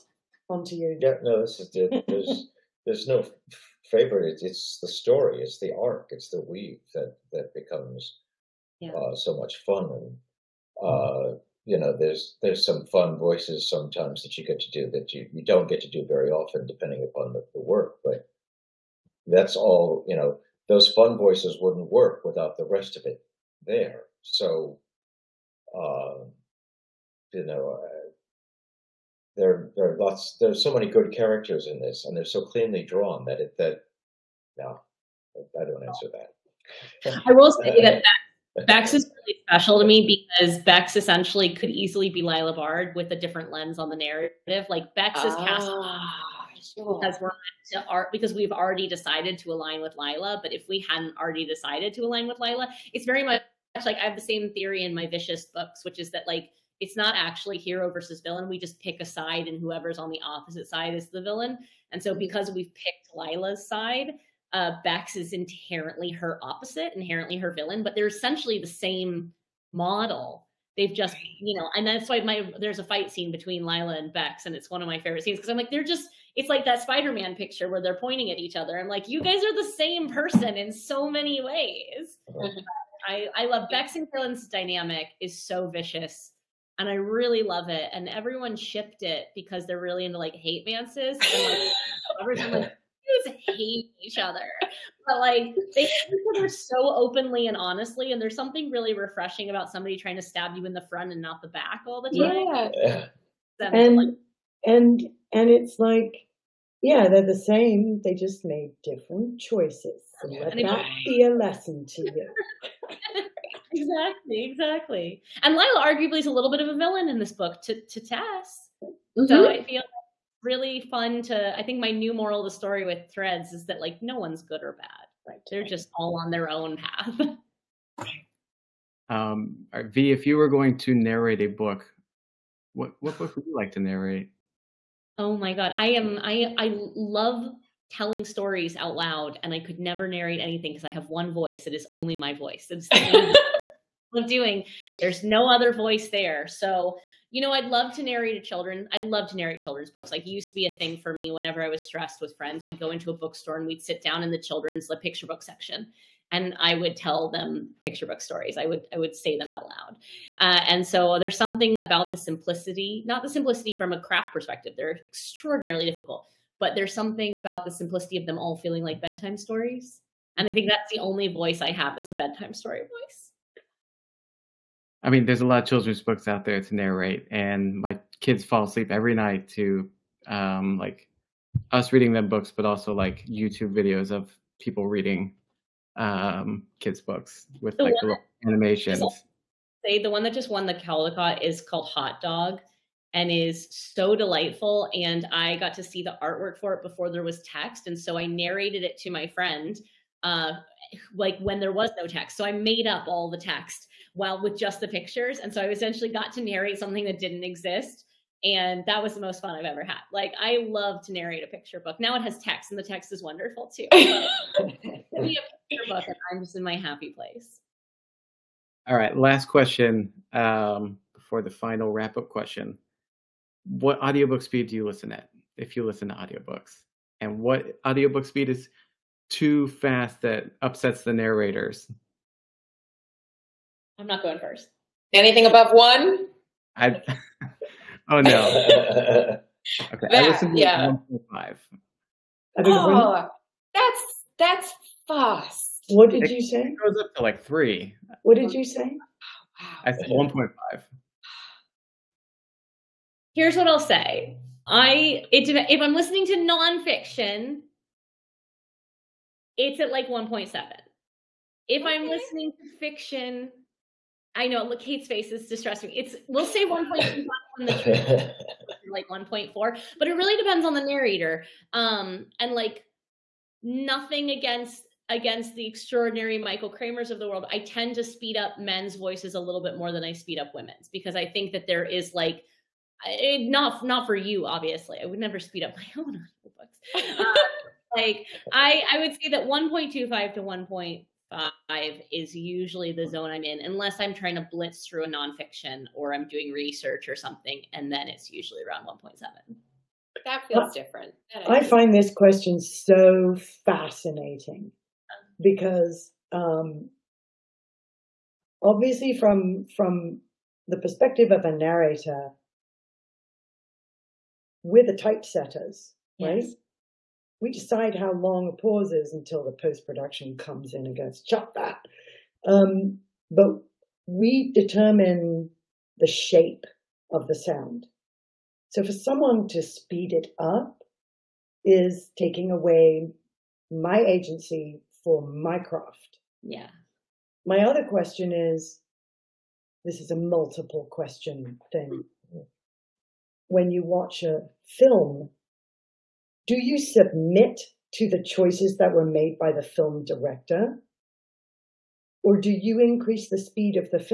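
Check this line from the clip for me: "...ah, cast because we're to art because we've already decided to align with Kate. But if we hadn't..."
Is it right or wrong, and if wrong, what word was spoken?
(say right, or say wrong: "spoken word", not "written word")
wrong: "Lila", not "Kate".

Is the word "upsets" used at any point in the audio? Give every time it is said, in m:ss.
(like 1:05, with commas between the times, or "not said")
3:50.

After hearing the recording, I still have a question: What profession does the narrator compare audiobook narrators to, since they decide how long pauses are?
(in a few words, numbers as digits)
Typesetters.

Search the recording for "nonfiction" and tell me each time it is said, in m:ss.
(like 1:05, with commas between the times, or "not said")
4:16, 4:55.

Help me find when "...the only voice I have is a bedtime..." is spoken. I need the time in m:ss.
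2:50.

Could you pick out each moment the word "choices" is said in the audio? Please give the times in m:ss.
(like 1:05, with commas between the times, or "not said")
1:49, 5:48.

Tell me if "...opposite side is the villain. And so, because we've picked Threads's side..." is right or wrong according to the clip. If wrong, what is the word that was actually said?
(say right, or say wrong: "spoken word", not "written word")
wrong: "Lila", not "Threads".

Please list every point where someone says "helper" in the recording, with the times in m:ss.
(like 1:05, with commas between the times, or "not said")
not said.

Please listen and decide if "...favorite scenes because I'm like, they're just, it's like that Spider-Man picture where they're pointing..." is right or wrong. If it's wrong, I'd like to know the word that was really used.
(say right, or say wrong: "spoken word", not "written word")
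right.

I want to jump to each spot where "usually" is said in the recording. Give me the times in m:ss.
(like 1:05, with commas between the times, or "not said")
4:52, 4:58.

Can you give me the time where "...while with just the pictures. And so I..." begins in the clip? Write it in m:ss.
3:24.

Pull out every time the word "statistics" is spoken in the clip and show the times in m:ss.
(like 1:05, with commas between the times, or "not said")
not said.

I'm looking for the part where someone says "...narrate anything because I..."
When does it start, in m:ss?
2:20.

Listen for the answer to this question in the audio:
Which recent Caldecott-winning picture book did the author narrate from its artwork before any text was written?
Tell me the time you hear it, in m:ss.
3:11.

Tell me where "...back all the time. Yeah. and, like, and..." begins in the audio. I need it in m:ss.
1:41.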